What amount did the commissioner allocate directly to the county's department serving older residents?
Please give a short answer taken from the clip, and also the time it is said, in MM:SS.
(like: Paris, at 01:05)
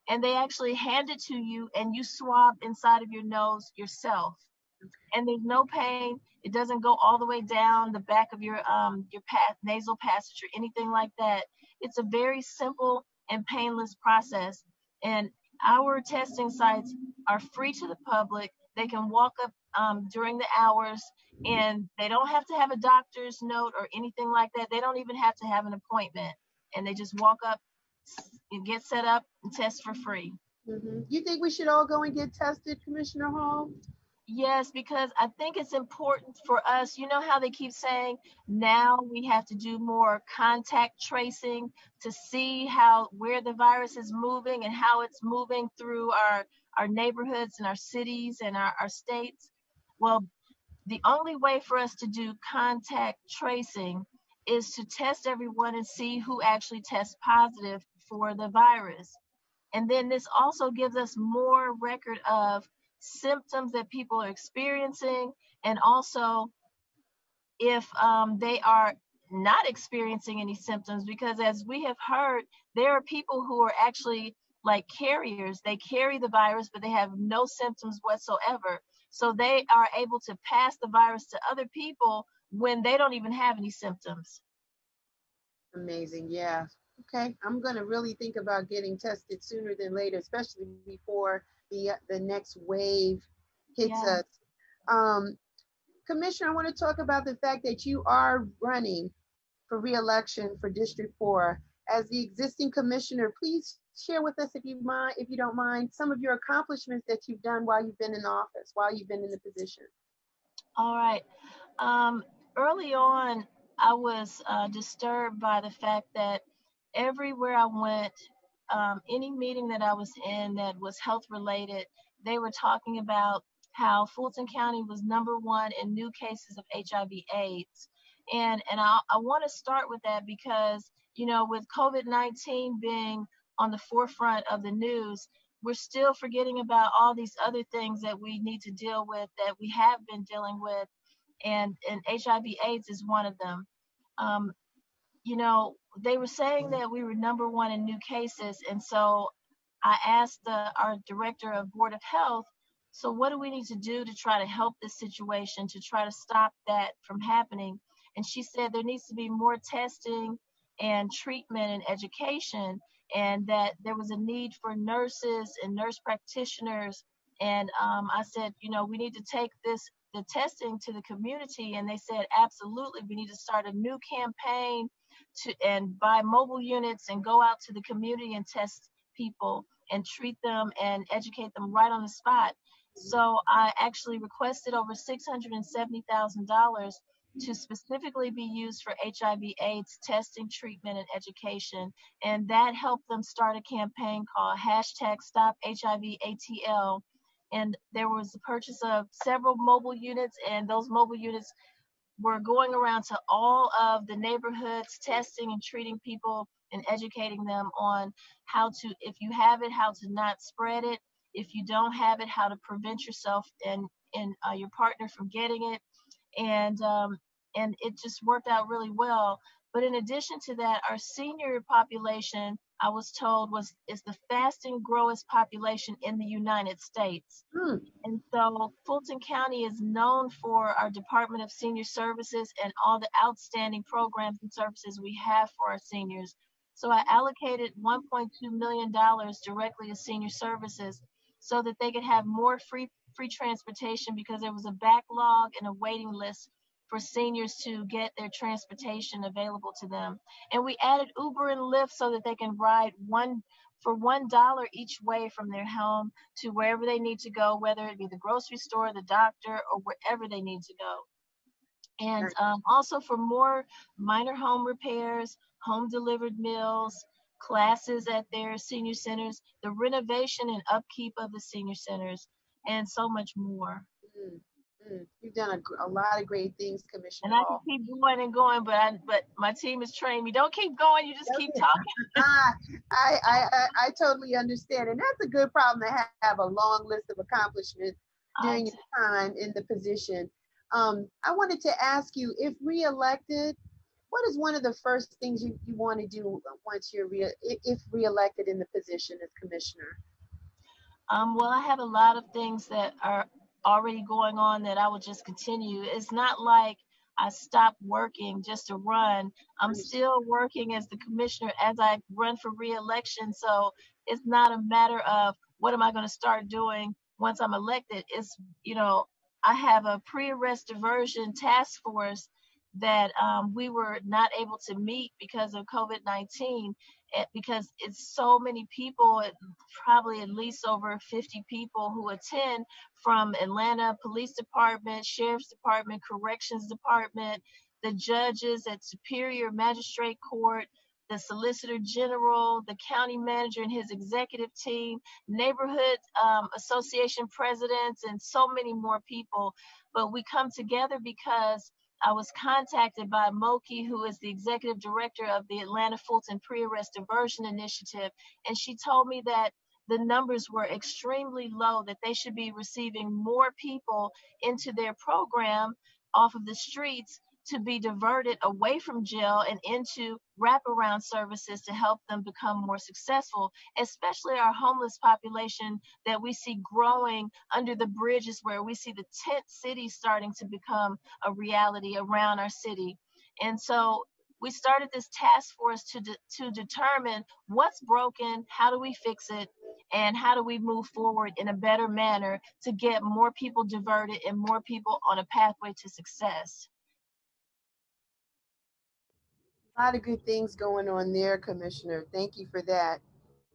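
$1.2 million, at 03:57.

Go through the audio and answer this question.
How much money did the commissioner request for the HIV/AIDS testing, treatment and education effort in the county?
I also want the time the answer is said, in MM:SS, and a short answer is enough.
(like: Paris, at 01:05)
over $670,000, at 03:04.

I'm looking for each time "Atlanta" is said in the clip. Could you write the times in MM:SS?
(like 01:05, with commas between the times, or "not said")
05:33, 05:55.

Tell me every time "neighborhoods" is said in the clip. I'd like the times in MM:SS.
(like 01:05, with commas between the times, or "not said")
00:46, 03:24, 05:45.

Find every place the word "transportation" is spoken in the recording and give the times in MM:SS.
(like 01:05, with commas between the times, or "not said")
04:03, 04:08.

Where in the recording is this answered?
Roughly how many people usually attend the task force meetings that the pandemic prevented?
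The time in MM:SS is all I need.
05:30.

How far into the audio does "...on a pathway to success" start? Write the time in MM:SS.
06:35.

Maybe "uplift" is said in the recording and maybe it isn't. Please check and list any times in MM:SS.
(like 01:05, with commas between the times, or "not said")
not said.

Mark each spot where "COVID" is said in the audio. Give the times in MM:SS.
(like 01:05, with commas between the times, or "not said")
02:11, 05:25.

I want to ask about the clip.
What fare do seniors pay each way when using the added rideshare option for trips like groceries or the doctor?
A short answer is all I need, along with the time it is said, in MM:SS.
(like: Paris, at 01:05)
$1, at 04:13.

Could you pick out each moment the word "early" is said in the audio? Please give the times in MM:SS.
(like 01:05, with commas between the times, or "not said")
01:52.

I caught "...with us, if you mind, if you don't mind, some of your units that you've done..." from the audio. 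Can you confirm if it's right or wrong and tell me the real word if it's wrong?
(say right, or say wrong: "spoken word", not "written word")
wrong: "accomplishments", not "units".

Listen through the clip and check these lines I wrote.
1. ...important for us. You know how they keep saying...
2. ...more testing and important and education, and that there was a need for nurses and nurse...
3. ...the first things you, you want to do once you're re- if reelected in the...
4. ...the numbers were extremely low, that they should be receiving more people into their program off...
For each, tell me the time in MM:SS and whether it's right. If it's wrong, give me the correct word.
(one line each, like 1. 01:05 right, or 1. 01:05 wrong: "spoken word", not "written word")
1. 00:35 right
2. 02:39 wrong: "treatment", not "important"
3. 04:54 right
4. 05:59 right.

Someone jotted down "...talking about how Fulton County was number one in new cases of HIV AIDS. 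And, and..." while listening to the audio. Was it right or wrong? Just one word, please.
right.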